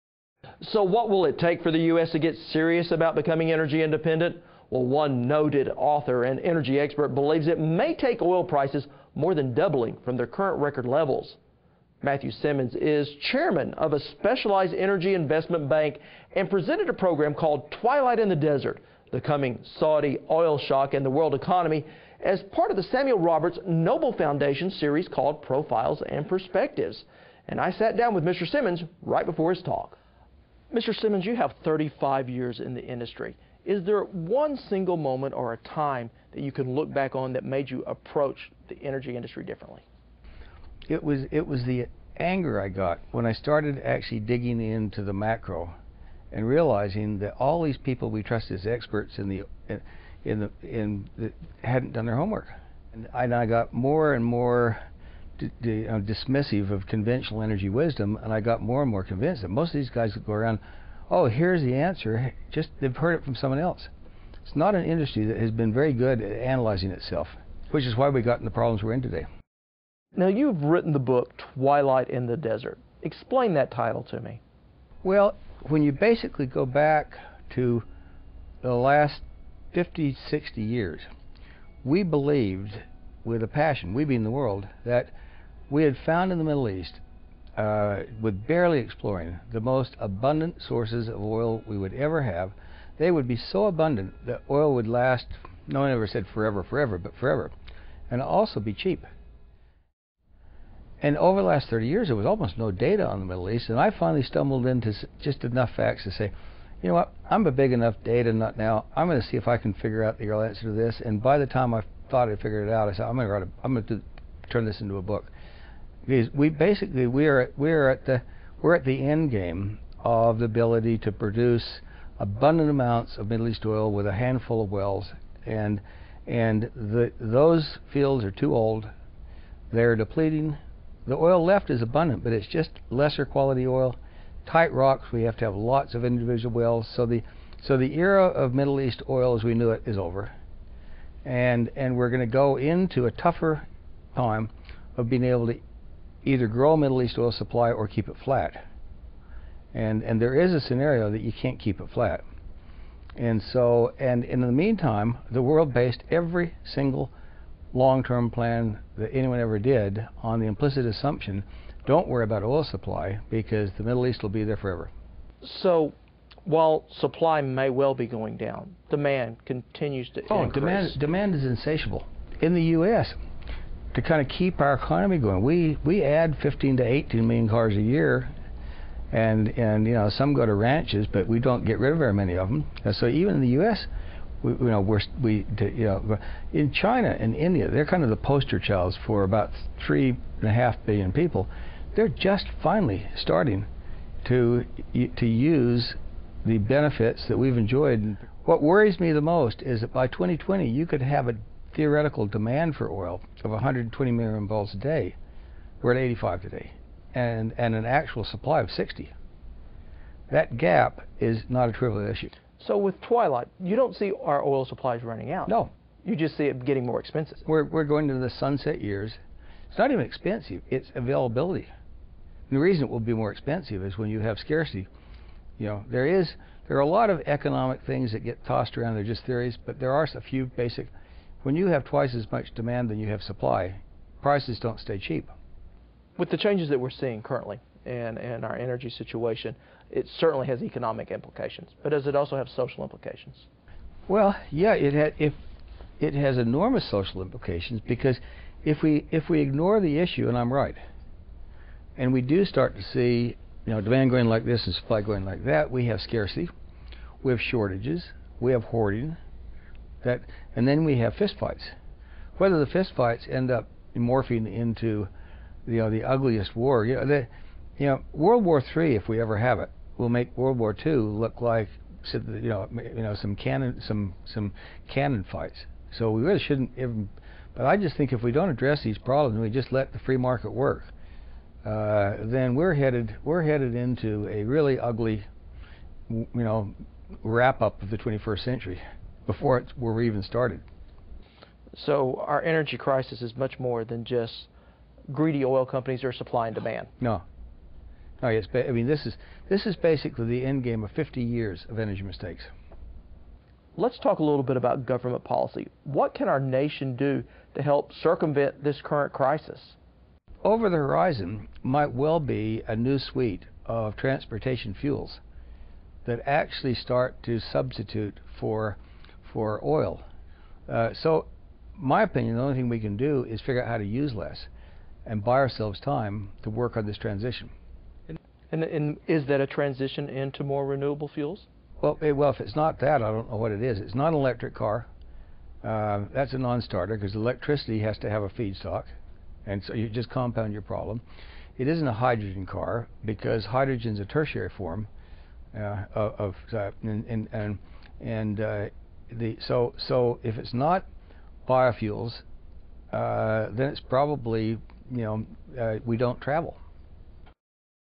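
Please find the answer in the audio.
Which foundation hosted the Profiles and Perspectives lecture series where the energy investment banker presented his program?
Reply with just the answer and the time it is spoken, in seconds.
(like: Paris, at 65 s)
Samuel Roberts Noble Foundation, at 22 s.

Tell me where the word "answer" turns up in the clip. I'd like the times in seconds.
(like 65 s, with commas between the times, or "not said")
61 s, 110 s.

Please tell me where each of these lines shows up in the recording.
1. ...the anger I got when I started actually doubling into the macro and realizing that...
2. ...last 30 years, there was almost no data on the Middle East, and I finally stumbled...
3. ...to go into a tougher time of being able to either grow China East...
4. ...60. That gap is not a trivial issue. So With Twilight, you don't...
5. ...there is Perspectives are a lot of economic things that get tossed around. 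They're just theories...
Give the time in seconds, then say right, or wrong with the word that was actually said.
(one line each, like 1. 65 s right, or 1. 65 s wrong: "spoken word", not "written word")
1. 41 s wrong: "digging", not "doubling"
2. 101 s right
3. 142 s wrong: "Middle", not "China"
4. 208 s right
5. 225 s wrong: "There", not "Perspectives".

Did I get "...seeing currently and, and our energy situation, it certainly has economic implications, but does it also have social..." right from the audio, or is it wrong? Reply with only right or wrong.
right.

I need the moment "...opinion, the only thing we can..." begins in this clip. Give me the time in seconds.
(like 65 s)
322 s.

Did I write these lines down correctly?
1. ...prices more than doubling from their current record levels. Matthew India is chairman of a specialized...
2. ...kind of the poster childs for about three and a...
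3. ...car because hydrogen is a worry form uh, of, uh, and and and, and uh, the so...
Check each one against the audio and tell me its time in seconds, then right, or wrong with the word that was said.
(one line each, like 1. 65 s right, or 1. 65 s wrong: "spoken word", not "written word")
1. 8 s wrong: "Simmons", not "India"
2. 187 s right
3. 342 s wrong: "tertiary", not "worry".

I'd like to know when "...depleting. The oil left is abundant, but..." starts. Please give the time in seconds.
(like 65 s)
129 s.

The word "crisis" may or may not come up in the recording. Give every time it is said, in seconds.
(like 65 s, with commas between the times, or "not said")
292 s, 309 s.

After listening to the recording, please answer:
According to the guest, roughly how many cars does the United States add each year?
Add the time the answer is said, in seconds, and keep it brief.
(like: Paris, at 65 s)
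15 to 18 million, at 176 s.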